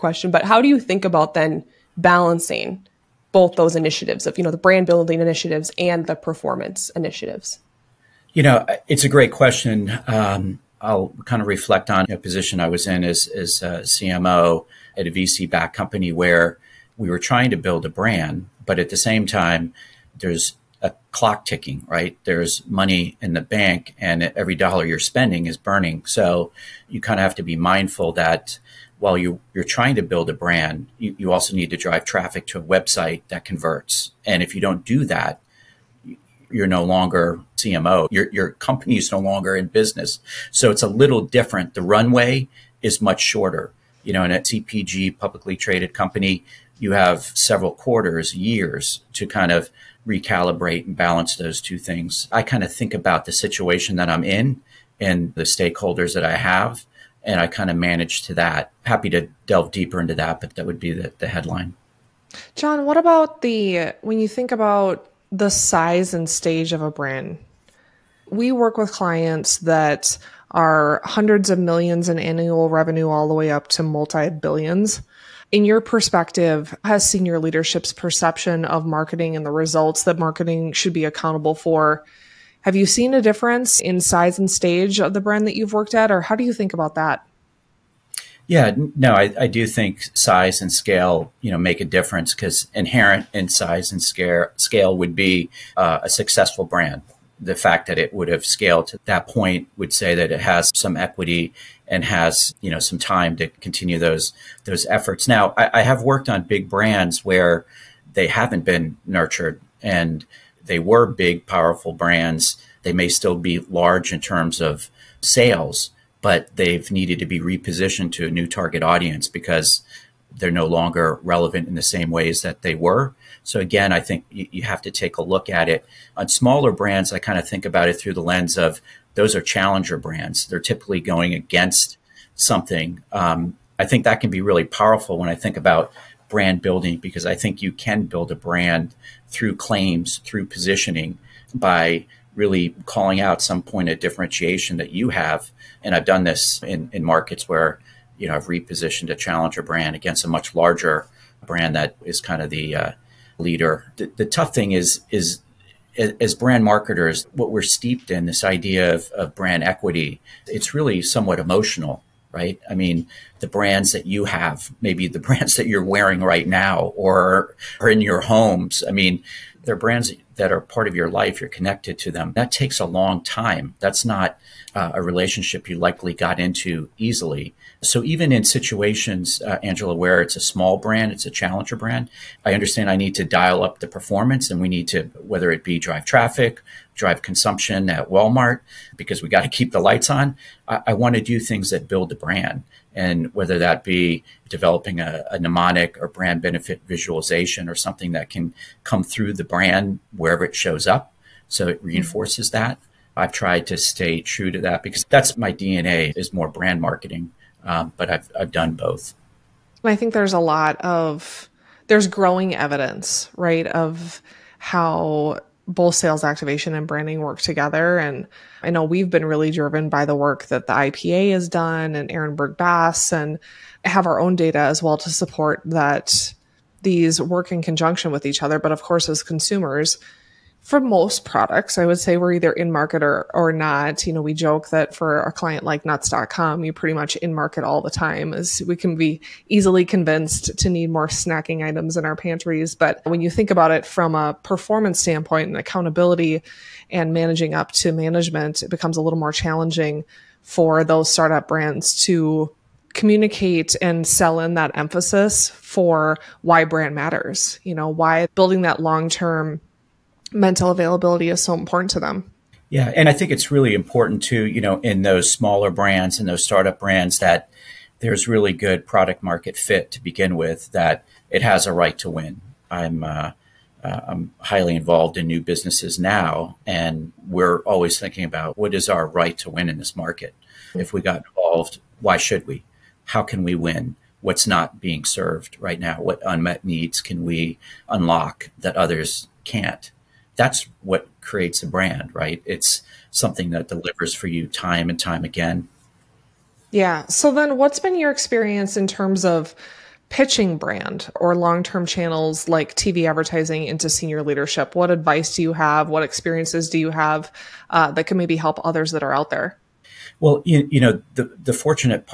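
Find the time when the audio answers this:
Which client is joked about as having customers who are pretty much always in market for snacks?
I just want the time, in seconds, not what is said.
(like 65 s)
235 s.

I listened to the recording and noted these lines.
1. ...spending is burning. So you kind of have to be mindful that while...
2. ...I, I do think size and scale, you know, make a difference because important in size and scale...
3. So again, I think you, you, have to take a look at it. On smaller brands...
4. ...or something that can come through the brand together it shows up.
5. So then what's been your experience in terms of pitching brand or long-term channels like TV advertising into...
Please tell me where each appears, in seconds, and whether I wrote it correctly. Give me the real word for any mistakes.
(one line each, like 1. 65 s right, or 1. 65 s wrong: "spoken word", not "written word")
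1. 24 s right
2. 89 s wrong: "inherent", not "important"
3. 123 s right
4. 197 s wrong: "wherever", not "together"
5. 297 s right.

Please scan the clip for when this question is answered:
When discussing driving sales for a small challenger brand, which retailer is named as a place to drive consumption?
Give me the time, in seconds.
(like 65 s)
188 s.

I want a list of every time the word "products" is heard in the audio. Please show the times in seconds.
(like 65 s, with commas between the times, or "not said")
231 s, 268 s.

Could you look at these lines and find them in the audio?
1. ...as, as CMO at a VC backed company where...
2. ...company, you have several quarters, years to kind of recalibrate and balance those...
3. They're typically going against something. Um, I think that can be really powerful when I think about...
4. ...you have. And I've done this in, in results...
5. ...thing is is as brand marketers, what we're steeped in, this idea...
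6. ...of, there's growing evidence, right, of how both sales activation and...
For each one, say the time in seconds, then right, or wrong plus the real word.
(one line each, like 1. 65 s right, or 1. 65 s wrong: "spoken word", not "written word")
1. 13 s right
2. 45 s right
3. 130 s right
4. 144 s wrong: "markets", not "results"
5. 154 s right
6. 210 s right.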